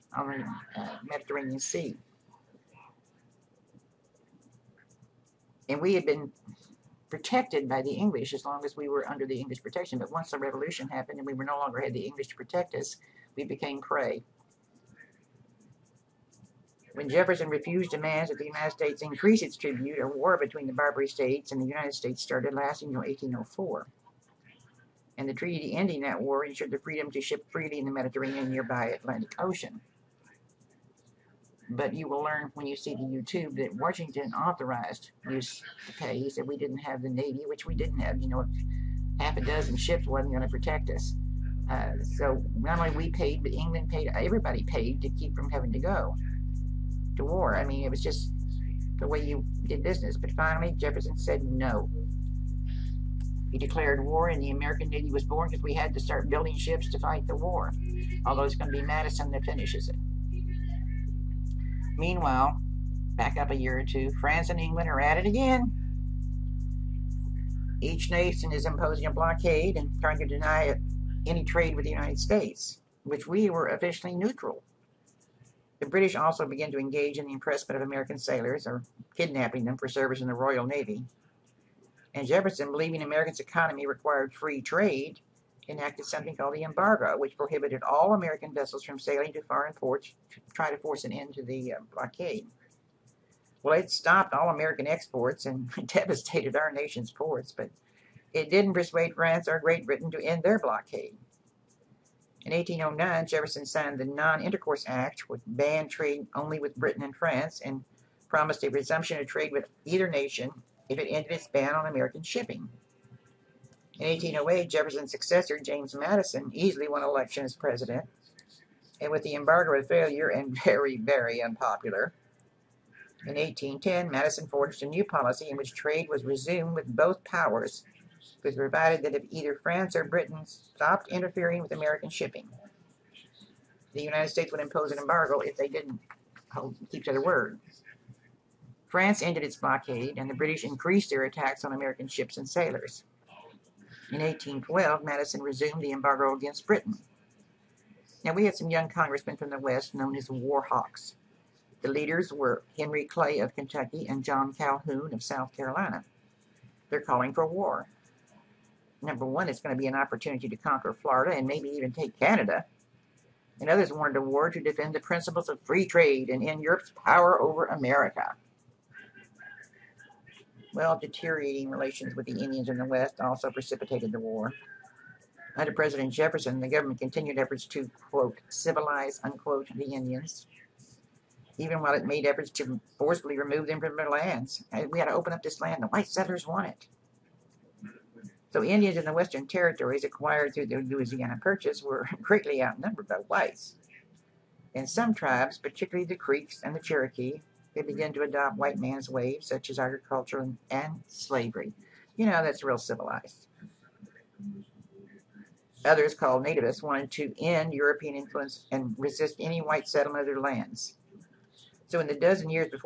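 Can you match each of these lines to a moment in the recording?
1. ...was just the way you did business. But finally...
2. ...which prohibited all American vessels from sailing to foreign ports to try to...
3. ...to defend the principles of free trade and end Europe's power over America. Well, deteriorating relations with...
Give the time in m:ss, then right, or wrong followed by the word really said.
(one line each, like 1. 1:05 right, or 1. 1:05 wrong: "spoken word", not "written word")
1. 0:47 right
2. 1:27 right
3. 2:44 right.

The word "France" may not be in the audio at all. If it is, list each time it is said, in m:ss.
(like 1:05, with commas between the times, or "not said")
1:04, 1:39, 1:47, 2:09, 2:18.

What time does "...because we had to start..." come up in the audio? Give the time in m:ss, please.
0:55.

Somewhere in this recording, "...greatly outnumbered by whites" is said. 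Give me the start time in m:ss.
3:12.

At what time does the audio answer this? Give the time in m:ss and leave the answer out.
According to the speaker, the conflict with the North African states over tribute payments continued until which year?
0:23.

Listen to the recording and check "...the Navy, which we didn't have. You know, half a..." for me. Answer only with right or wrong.
right.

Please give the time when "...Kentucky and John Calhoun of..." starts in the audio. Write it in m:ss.
2:33.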